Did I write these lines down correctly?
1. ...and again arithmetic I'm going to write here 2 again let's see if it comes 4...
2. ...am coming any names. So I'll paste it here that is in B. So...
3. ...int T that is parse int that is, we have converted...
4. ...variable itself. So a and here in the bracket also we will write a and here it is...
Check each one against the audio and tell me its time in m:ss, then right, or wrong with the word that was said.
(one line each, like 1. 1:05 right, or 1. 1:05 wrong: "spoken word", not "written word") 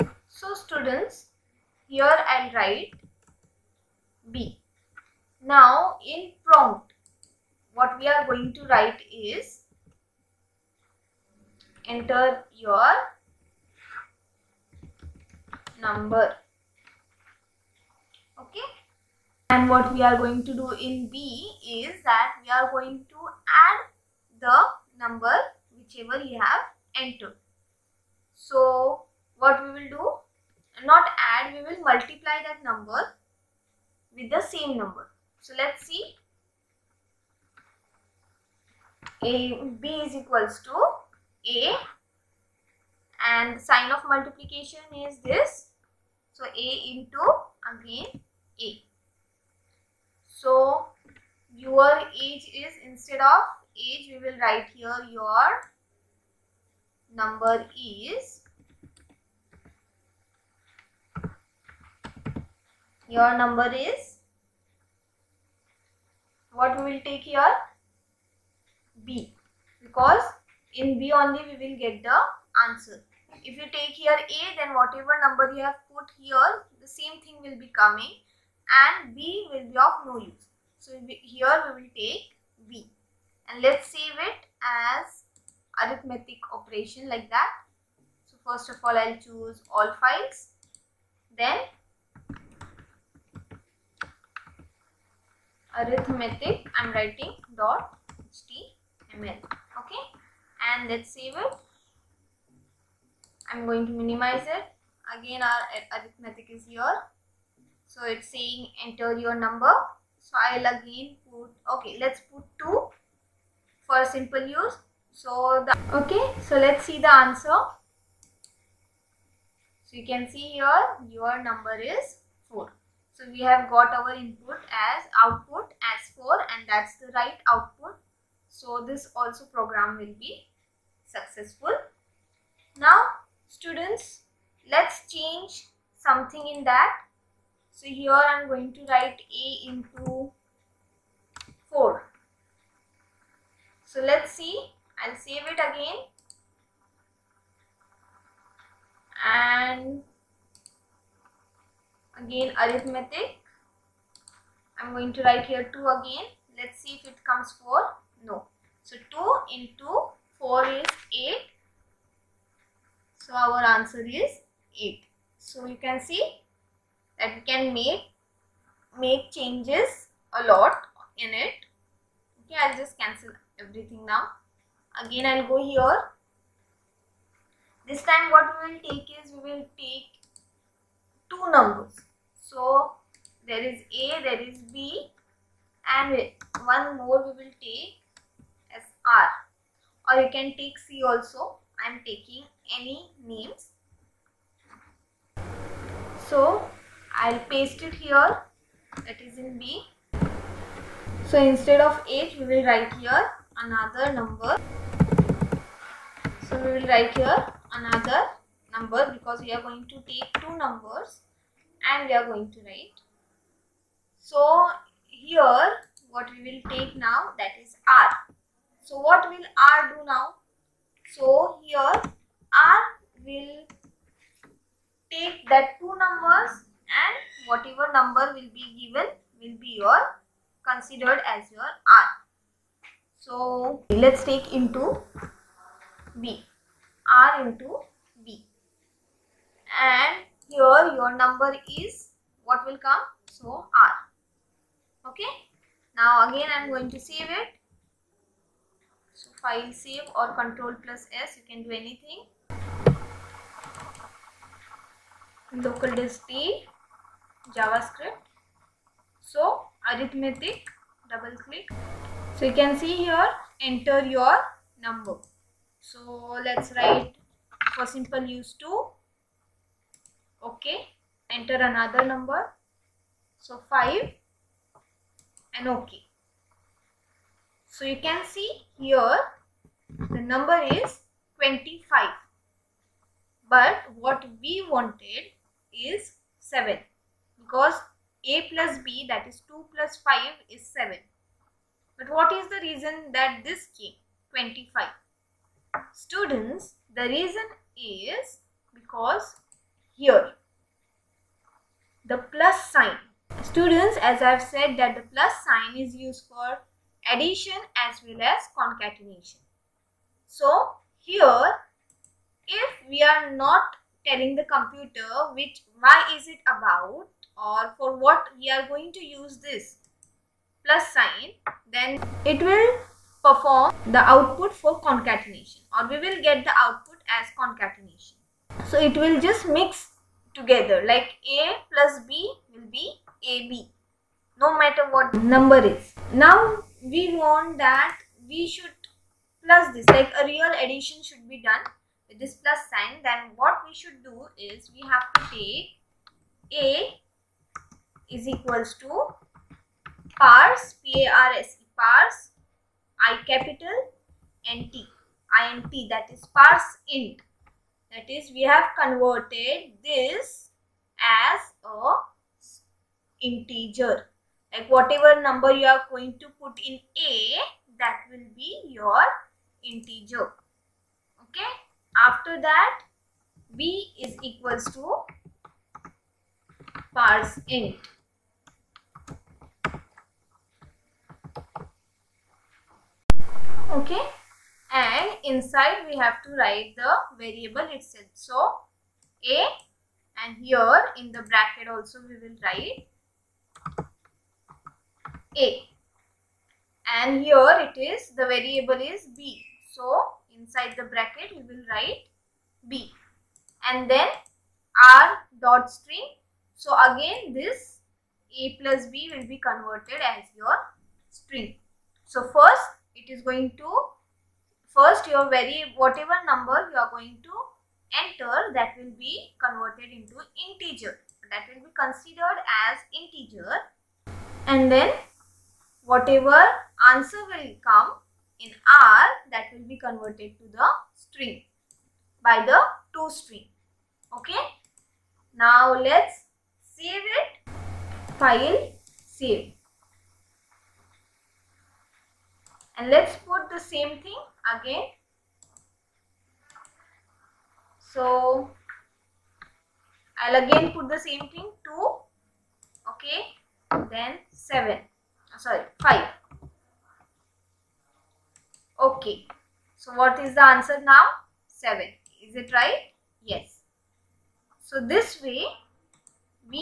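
1. 2:29 right
2. 3:11 wrong: "taking", not "coming"
3. 5:54 right
4. 6:27 right.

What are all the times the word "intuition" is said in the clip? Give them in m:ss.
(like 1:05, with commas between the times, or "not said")
not said.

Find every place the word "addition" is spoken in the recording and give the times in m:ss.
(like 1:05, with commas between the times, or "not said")
5:07, 5:40.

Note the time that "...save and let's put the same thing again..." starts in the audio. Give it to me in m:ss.
7:19.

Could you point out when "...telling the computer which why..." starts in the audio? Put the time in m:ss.
5:14.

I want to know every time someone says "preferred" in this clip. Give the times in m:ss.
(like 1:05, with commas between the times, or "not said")
not said.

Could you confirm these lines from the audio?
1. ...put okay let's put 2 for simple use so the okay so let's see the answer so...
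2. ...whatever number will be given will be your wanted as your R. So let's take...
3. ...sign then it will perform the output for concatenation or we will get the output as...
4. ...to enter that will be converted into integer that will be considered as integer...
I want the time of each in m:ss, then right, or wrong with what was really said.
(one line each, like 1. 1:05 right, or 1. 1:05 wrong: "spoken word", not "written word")
1. 1:51 right
2. 3:47 wrong: "considered", not "wanted"
3. 5:20 right
4. 6:57 right.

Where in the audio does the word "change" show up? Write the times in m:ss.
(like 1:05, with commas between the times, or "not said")
2:15, 2:49.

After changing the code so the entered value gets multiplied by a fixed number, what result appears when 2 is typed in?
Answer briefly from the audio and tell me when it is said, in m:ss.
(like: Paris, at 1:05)
8, at 2:43.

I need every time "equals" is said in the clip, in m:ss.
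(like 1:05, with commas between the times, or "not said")
0:40, 5:48, 6:14.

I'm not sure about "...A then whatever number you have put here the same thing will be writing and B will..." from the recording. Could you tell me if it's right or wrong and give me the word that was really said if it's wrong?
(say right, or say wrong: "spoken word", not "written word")
wrong: "coming", not "writing".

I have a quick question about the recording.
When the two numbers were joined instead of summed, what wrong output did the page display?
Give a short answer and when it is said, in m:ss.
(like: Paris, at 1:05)
25, at 4:40.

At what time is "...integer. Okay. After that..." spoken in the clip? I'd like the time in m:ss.
6:09.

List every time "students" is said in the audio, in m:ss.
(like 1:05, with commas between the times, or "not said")
0:00, 2:13, 4:56, 5:03.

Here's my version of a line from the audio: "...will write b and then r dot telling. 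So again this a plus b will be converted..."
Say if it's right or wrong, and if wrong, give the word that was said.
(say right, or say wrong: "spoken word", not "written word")
wrong: "string", not "telling".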